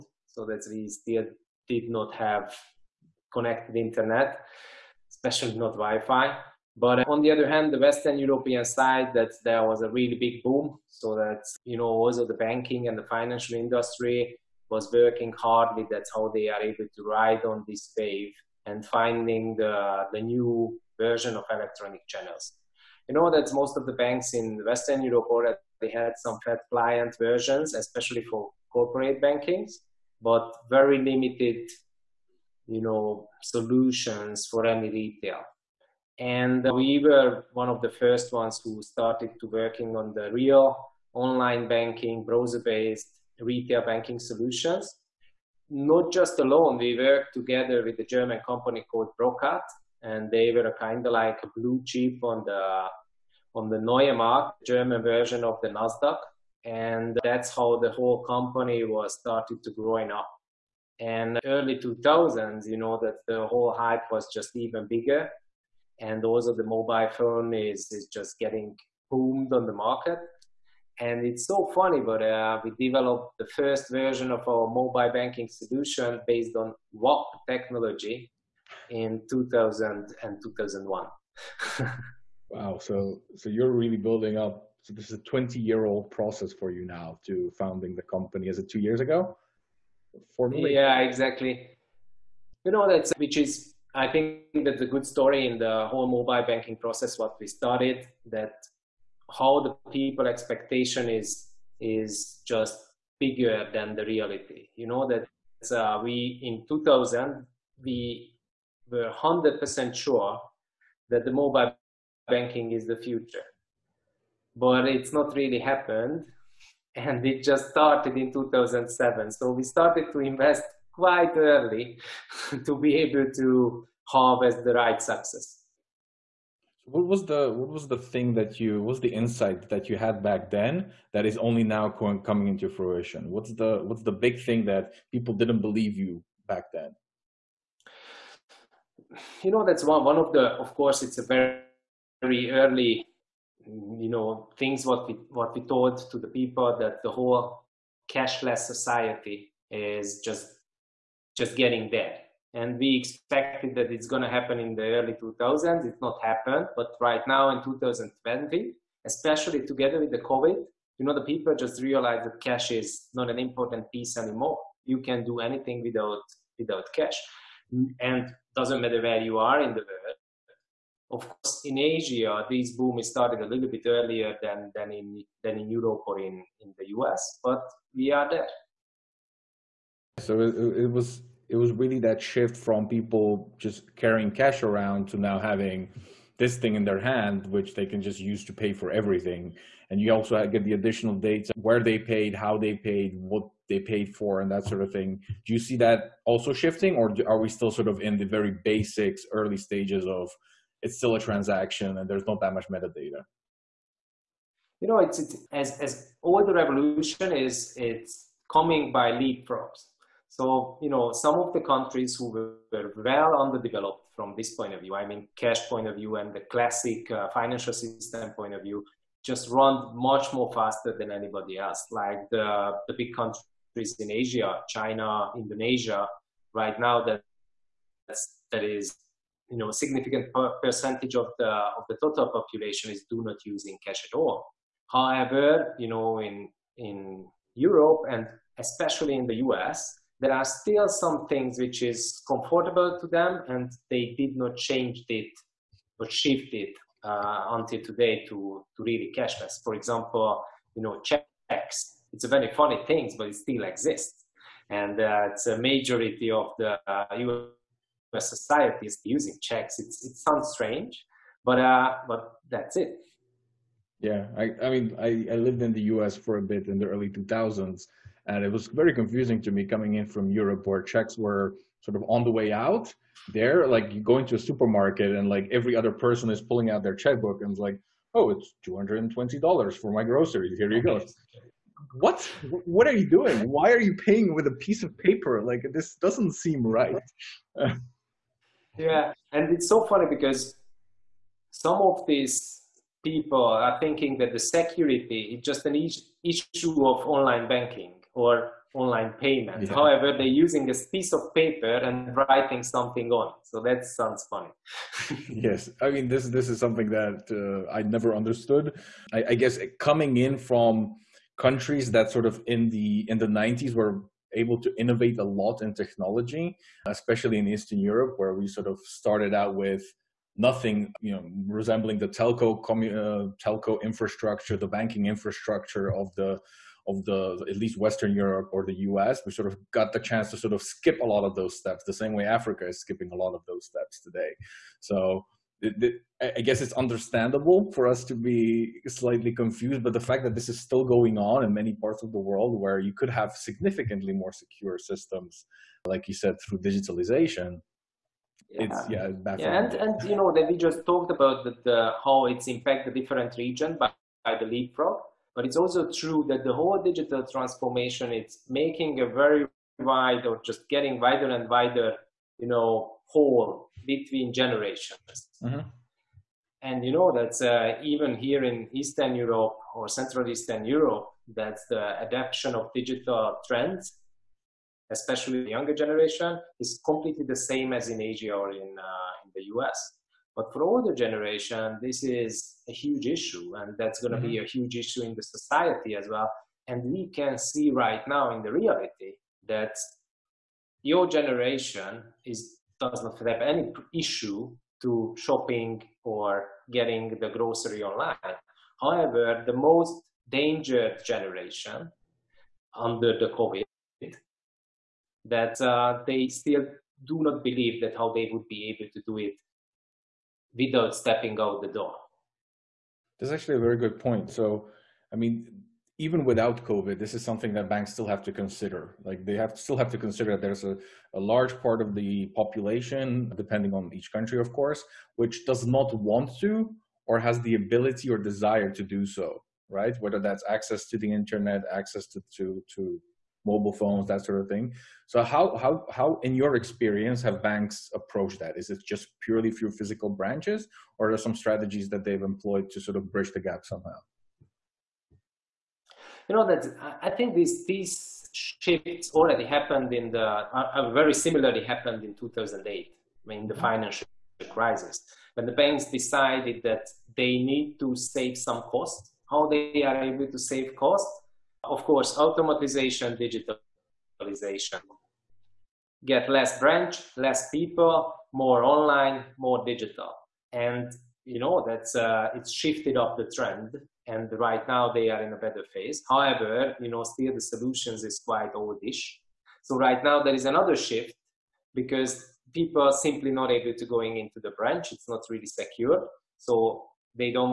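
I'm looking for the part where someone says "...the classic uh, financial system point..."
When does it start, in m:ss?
3:36.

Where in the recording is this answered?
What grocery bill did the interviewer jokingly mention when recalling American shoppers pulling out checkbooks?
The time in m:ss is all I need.
4:38.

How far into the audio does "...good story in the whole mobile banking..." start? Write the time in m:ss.
1:34.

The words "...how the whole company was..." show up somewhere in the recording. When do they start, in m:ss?
0:57.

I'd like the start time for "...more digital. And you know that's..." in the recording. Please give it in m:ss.
7:49.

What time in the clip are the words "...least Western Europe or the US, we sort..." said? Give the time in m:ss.
5:27.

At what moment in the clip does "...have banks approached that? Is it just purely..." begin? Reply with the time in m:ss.
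7:17.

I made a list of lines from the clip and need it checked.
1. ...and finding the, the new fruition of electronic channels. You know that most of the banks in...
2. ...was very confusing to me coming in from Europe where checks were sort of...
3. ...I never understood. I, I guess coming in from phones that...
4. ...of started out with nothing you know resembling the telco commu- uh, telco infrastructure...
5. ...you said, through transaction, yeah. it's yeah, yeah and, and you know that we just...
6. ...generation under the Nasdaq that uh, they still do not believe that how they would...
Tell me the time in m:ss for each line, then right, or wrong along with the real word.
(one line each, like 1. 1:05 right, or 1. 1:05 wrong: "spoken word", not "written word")
1. 0:18 wrong: "version", not "fruition"
2. 4:28 right
3. 5:07 wrong: "countries", not "phones"
4. 5:18 right
5. 5:46 wrong: "digitalization", not "transaction"
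6. 6:41 wrong: "COVID", not "Nasdaq".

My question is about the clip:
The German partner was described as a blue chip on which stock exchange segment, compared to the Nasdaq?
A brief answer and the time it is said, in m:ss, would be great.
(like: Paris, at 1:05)
Neue Markt, at 0:53.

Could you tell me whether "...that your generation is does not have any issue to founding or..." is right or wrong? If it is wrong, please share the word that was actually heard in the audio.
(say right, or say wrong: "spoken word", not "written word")
wrong: "shopping", not "founding".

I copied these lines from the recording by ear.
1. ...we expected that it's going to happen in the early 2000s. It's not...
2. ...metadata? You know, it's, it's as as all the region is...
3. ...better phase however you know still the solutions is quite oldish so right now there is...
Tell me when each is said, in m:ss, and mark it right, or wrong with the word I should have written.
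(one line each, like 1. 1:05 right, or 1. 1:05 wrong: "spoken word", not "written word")
1. 2:32 right
2. 3:22 wrong: "revolution", not "region"
3. 7:55 right.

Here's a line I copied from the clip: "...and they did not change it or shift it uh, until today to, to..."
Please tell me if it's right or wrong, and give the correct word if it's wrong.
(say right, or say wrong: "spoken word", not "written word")
right.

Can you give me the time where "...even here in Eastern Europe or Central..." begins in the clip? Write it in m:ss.
6:07.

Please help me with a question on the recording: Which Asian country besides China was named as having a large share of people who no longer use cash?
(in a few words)
Indonesia.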